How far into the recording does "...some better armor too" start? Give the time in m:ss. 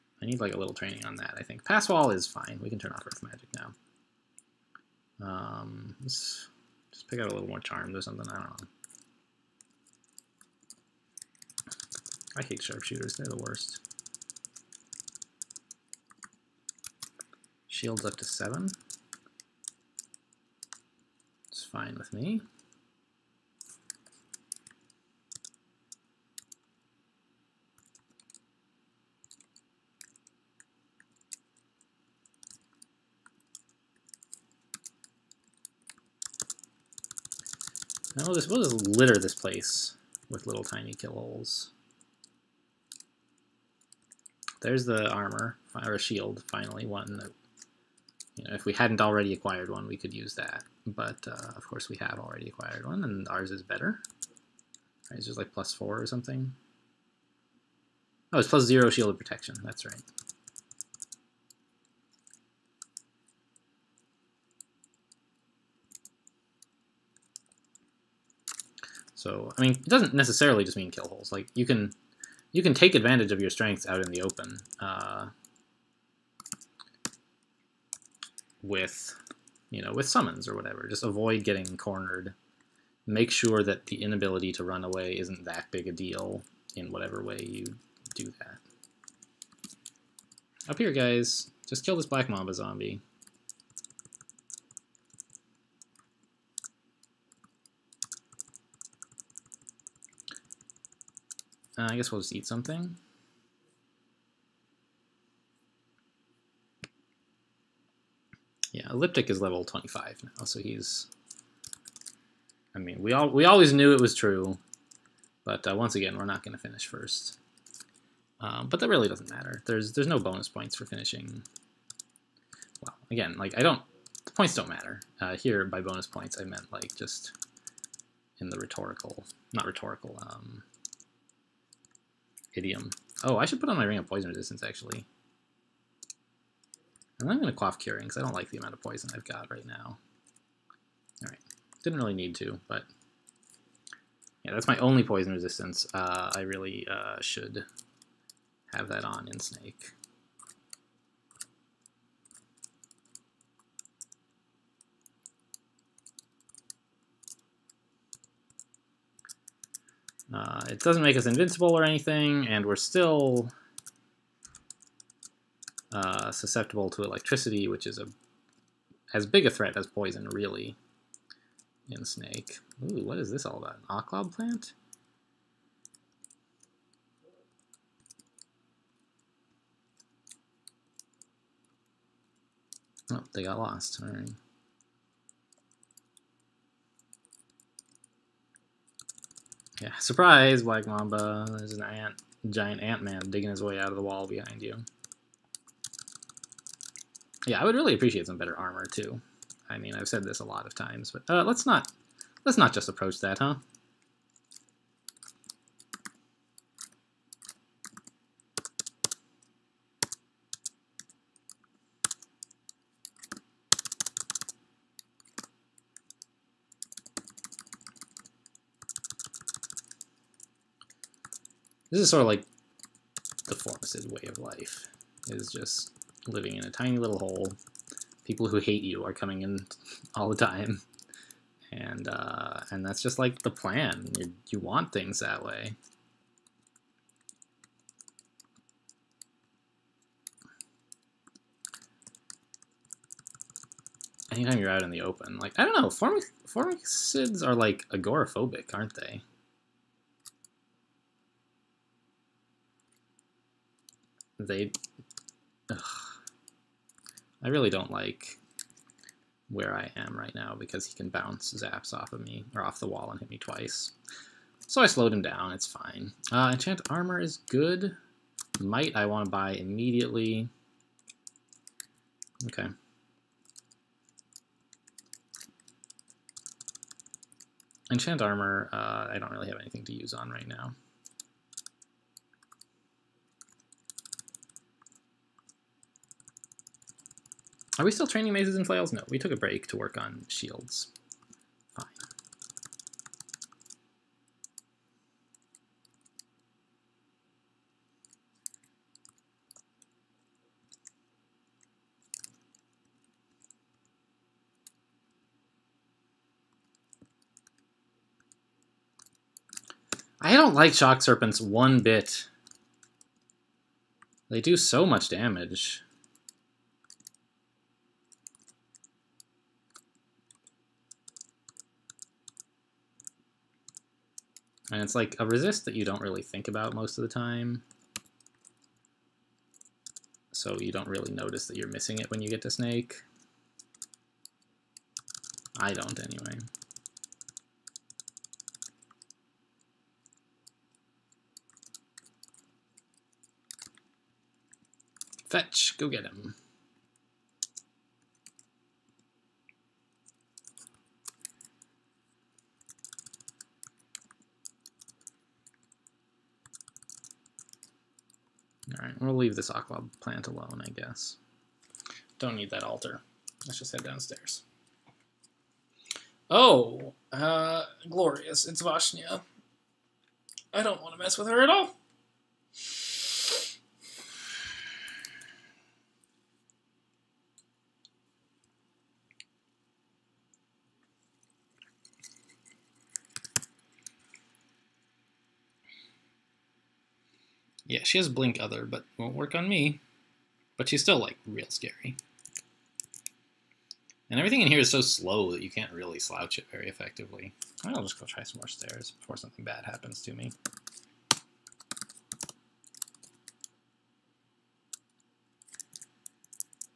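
3:18.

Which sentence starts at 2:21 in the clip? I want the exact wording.
All right, didn't really need to, but yeah, that's my only poison resistance.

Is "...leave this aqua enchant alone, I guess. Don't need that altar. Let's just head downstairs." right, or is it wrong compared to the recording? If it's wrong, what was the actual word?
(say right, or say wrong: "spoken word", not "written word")
wrong: "plant", not "enchant".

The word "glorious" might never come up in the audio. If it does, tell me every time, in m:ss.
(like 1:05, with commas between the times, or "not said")
6:07.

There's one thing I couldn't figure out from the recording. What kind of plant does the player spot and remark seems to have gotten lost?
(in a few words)
oklob plant.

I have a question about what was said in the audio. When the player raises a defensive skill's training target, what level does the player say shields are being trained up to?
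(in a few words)
7.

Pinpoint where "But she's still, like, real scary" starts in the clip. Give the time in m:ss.
6:30.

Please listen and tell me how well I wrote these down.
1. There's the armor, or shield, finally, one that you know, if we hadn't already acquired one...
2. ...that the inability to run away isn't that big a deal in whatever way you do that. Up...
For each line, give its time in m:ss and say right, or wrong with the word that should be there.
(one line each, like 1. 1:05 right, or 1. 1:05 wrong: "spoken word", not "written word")
1. 0:44 right
2. 1:23 right.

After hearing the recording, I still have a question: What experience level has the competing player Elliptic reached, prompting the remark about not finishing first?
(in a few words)
25.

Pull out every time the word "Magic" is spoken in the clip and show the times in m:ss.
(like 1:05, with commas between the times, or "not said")
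0:03.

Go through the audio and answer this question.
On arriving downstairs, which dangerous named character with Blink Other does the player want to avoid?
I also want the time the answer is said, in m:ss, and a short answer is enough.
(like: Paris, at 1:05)
Vashnia, at 6:08.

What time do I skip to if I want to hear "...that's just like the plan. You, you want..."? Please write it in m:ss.
3:52.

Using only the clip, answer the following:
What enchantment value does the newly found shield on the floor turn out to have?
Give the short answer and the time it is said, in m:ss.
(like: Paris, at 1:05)
plus zero, at 0:58.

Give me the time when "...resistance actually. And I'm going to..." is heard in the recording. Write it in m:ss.
2:14.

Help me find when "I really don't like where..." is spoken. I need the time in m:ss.
4:17.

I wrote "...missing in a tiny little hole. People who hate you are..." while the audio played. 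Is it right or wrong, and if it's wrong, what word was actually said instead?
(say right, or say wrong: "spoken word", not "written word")
wrong: "living", not "missing".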